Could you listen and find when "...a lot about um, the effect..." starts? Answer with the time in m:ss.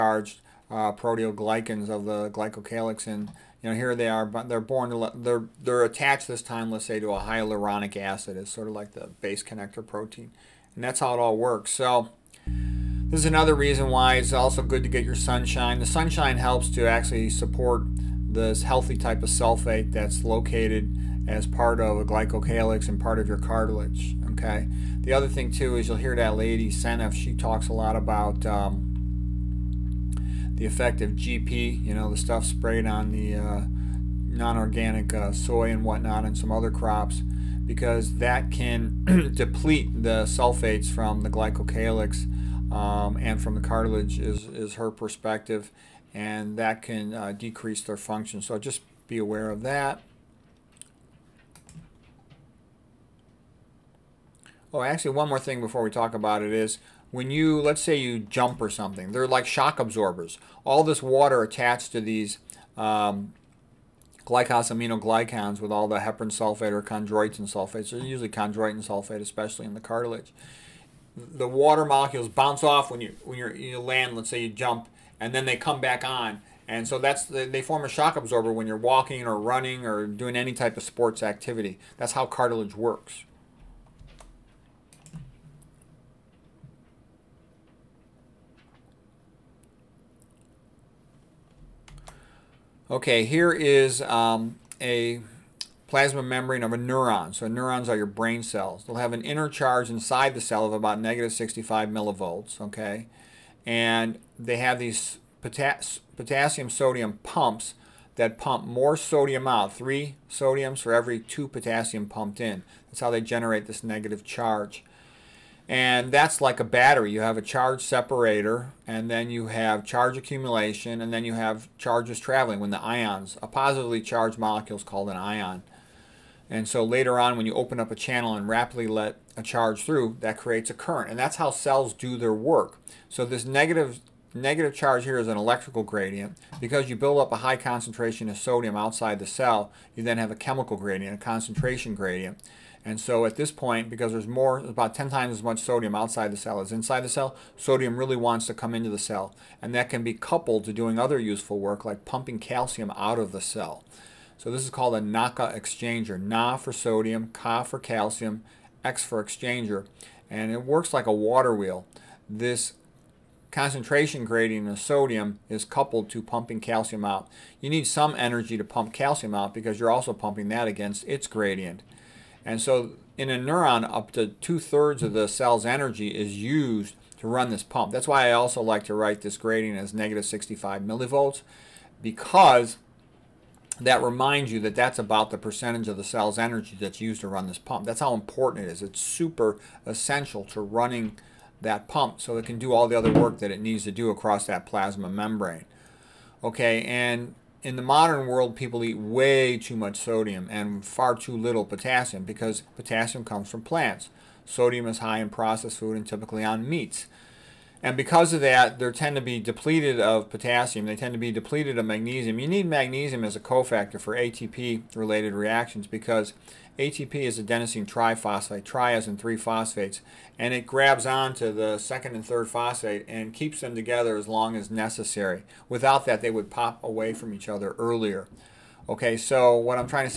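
0:27.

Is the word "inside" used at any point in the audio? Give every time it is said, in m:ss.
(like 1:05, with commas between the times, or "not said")
1:39, 2:26.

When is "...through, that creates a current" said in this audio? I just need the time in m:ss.
2:09.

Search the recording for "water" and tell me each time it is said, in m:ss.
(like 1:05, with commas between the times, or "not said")
1:01, 1:11, 2:41.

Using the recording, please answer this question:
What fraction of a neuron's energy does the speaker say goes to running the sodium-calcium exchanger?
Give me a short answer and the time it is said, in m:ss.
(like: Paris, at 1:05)
Two-thirds, at 2:54.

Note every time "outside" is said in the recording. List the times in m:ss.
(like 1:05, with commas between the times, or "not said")
2:18, 2:25.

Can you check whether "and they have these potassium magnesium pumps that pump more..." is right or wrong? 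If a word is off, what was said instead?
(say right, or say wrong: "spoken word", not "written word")
wrong: "sodium", not "magnesium".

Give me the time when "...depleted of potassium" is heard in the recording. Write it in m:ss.
3:29.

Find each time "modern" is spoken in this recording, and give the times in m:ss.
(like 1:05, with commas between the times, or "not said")
3:17.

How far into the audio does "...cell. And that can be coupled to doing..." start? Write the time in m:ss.
2:28.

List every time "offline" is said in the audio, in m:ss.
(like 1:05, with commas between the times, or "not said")
not said.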